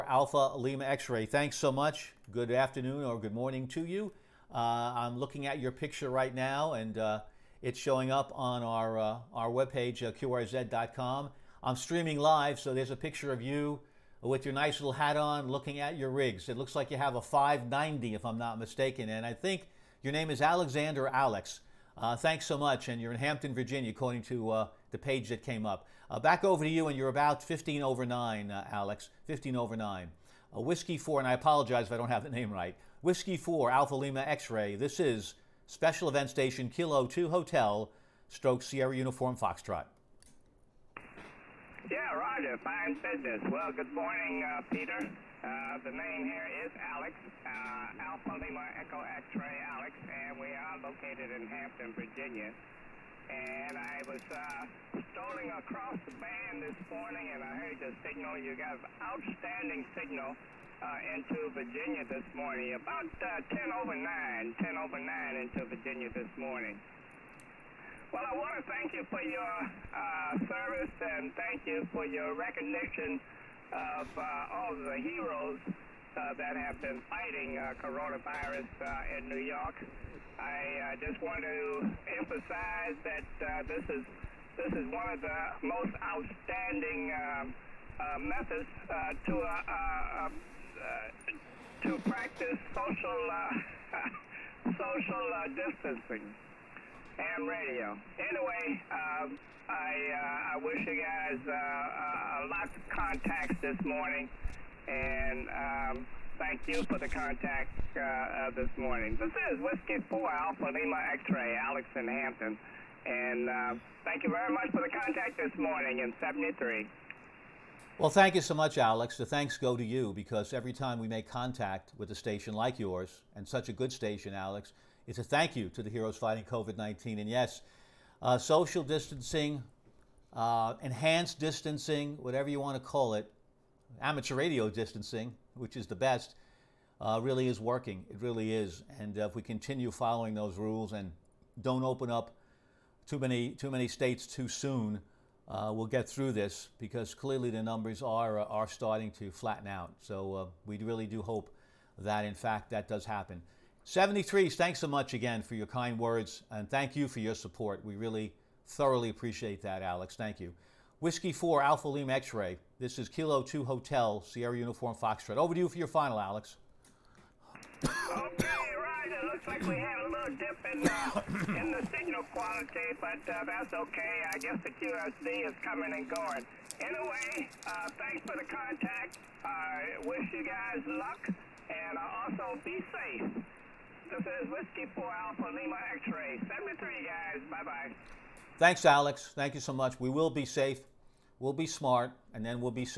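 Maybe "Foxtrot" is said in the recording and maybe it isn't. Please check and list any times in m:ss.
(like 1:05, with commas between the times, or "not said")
0:39, 2:44.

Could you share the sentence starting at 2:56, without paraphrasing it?
Anyway, uh, thanks for the contact.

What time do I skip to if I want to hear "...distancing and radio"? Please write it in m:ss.
1:35.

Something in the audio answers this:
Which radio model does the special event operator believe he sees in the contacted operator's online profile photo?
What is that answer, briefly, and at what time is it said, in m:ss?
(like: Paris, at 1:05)
590, at 0:17.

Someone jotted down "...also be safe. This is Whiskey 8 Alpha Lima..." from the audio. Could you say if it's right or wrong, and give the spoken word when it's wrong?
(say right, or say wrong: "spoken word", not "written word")
wrong: "4", not "8".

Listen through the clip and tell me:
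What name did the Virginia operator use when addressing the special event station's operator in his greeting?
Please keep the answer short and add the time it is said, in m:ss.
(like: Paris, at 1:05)
Peter, at 0:44.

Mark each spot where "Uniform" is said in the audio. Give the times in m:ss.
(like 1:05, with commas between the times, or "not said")
0:38, 2:44.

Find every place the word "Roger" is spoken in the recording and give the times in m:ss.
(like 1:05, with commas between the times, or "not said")
0:42.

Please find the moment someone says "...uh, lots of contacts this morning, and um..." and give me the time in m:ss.
1:41.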